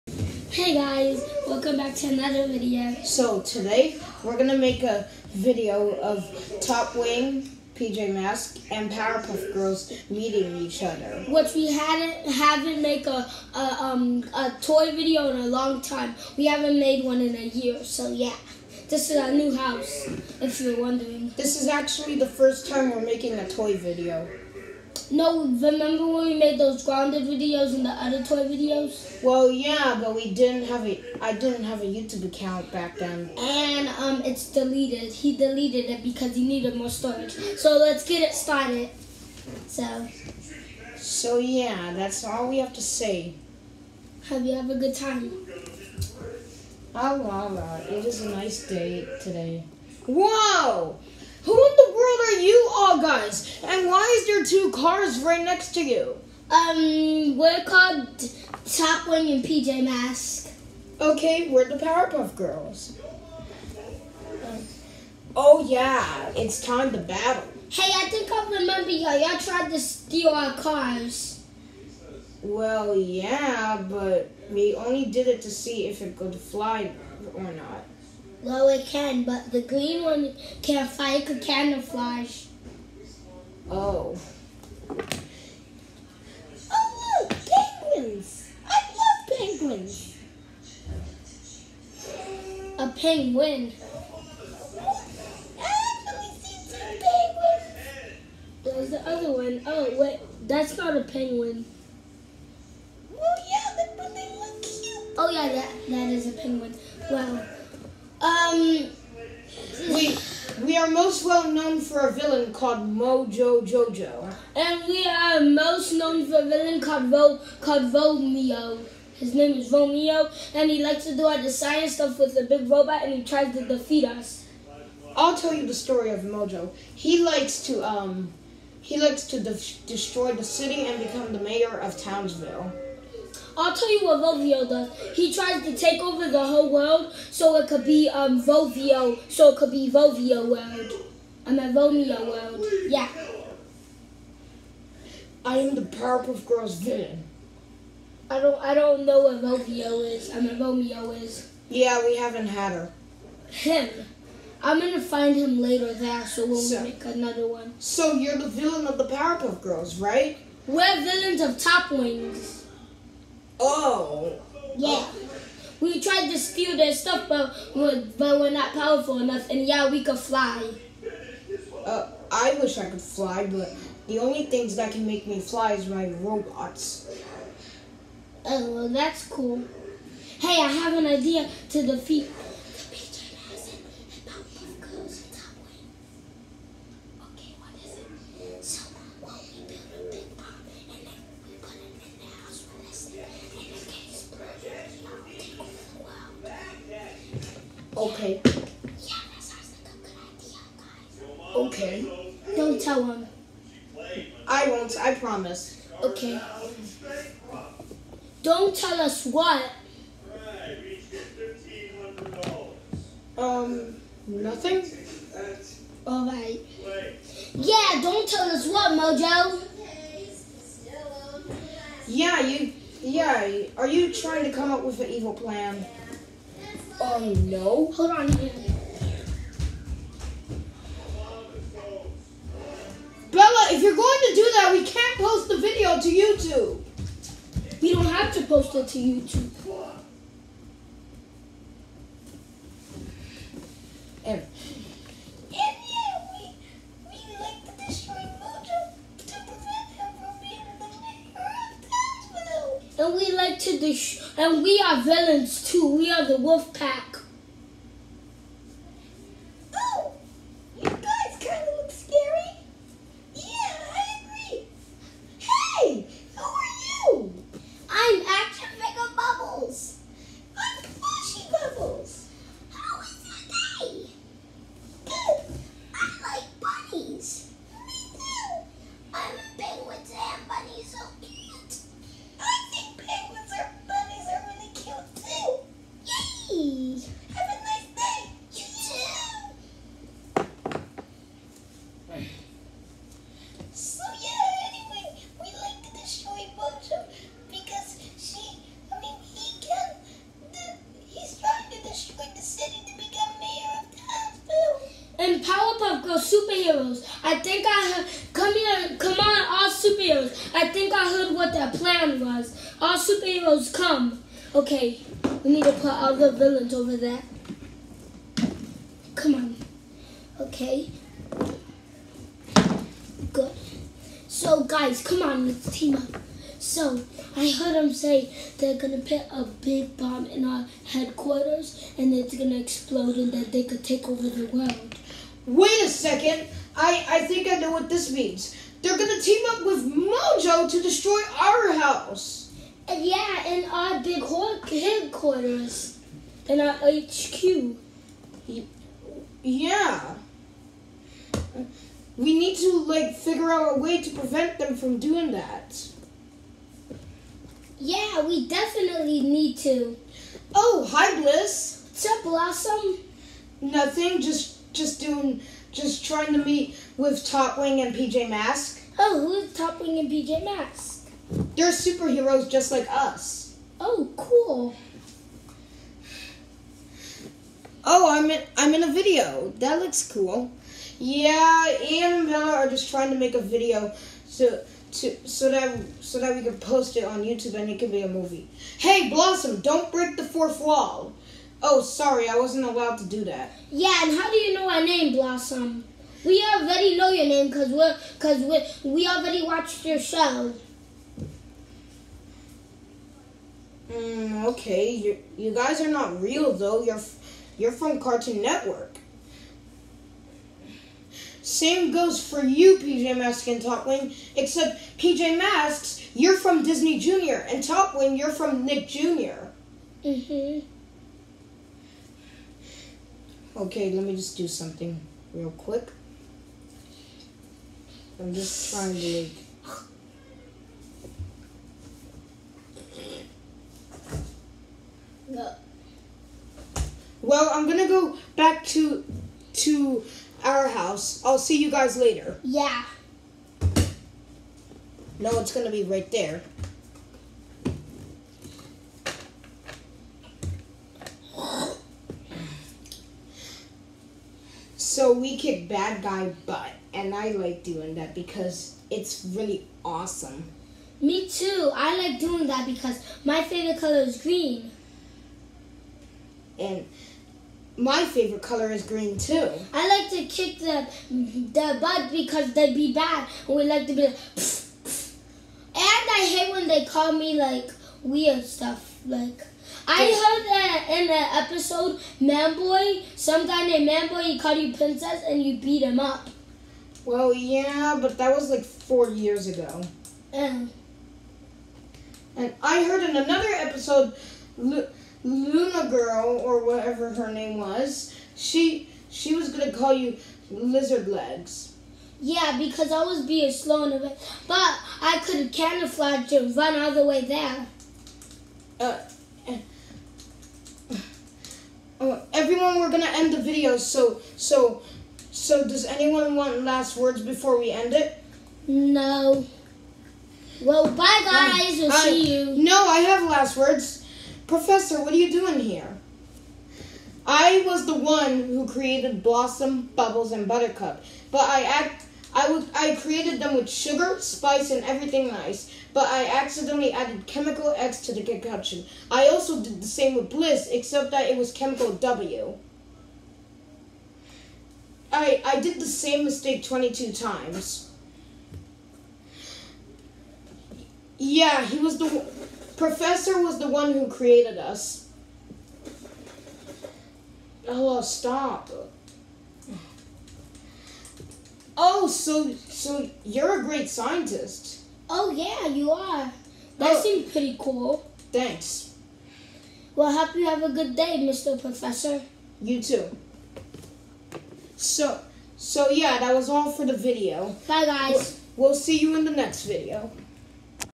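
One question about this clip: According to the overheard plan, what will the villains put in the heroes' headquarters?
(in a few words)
a big bomb.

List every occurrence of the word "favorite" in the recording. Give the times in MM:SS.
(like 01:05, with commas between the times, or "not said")
07:43, 07:48.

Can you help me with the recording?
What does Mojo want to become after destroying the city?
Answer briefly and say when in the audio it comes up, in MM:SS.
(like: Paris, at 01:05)
mayor of Townsville, at 02:11.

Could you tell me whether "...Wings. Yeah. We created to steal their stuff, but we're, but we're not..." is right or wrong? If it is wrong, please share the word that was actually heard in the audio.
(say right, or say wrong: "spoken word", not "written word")
wrong: "tried", not "created".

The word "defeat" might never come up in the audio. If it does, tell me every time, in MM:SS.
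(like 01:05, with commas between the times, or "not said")
02:03, 03:01.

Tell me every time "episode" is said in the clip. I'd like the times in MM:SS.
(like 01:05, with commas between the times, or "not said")
08:01, 08:13.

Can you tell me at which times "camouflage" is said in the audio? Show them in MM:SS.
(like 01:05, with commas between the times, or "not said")
01:21, 08:25.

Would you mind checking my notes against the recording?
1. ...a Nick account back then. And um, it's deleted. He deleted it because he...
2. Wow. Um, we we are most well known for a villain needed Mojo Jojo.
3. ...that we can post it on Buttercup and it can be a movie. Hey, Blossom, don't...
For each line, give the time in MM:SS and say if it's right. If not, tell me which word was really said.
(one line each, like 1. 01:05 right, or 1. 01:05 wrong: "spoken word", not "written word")
1. 00:31 wrong: "YouTube", not "Nick"
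2. 01:47 wrong: "called", not "needed"
3. 06:26 wrong: "YouTube", not "Buttercup".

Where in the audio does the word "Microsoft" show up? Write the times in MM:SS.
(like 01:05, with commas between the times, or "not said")
not said.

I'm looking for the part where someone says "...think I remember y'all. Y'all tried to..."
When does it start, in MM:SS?
01:08.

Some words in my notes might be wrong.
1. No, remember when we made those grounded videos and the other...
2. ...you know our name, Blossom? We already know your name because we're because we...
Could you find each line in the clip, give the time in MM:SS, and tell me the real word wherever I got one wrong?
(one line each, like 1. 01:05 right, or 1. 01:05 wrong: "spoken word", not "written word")
1. 00:25 right
2. 06:34 right.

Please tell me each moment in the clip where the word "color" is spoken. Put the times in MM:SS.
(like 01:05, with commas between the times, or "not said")
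07:43, 07:48.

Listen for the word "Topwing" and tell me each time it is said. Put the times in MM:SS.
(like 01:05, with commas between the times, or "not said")
06:53, 06:57.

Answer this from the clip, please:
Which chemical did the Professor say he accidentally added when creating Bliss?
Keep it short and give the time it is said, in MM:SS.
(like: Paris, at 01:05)
chemical W, at 09:01.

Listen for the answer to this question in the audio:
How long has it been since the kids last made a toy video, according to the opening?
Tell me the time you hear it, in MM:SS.
00:16.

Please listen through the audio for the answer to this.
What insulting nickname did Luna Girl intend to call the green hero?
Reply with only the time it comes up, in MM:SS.
08:20.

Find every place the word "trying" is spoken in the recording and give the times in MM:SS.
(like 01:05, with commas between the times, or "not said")
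03:44, 06:06, 06:22, 07:08.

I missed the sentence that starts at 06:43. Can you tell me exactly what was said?
Mm, okay, you you guys are not real though.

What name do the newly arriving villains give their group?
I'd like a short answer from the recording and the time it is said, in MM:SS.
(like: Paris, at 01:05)
the wolf pack, at 04:15.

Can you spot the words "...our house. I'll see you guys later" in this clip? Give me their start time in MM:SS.
07:20.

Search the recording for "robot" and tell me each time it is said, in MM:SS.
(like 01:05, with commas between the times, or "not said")
02:02, 02:56.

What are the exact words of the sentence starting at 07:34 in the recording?
So we kick bad guy butt, and I like doing that because it's really awesome.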